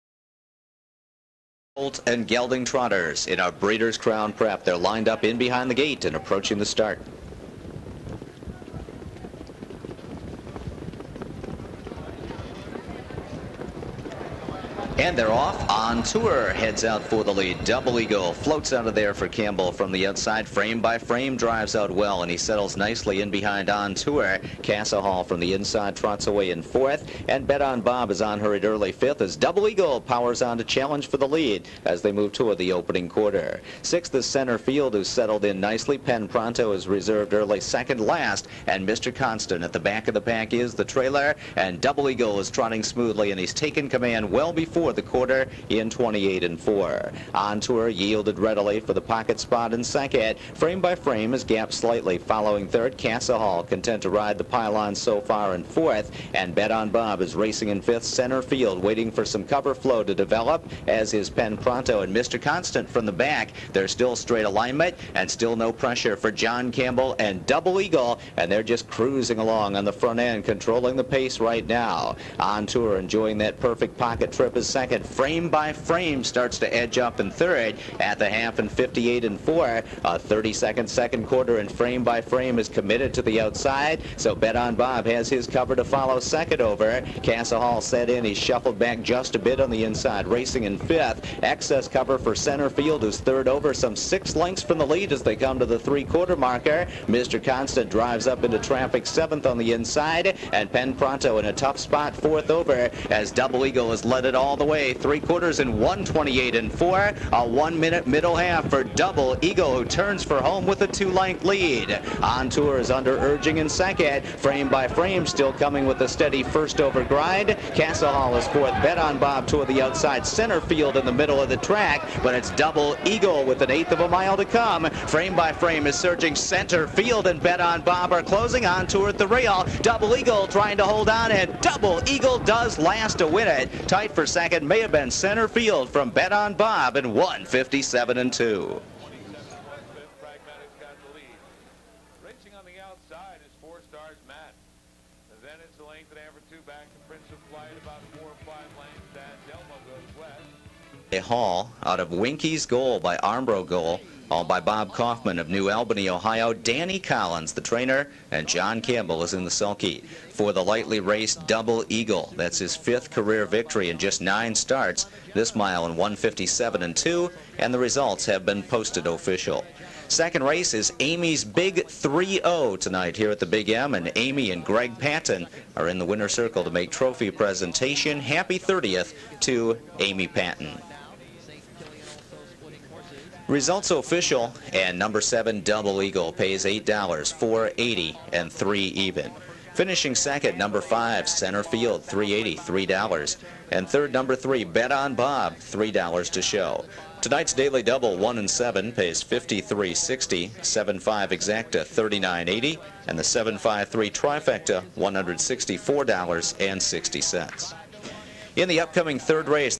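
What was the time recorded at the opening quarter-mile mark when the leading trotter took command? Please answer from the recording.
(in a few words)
28 and 4.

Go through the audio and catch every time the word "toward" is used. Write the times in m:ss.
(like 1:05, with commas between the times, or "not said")
0:32, 1:59.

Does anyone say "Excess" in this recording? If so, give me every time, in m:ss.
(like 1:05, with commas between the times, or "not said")
1:31.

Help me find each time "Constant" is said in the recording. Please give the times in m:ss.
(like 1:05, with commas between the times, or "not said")
0:39, 1:02, 1:37.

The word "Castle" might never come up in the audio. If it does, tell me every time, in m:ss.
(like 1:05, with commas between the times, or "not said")
0:52, 1:57.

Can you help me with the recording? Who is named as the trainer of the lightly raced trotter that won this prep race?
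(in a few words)
Danny Collins.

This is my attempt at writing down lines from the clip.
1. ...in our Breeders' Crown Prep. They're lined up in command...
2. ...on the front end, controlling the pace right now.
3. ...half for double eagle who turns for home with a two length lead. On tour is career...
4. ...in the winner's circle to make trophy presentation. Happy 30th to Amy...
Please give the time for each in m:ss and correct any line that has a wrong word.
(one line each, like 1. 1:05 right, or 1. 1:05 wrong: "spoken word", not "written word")
1. 0:03 wrong: "behind", not "command"
2. 1:09 right
3. 1:48 wrong: "under", not "career"
4. 2:55 right.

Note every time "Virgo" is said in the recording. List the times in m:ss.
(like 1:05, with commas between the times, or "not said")
not said.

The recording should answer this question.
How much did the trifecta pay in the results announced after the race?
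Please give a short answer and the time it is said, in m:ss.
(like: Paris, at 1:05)
$164.60, at 3:24.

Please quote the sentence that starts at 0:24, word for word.
Casa Hall from the inside trots away in fourth.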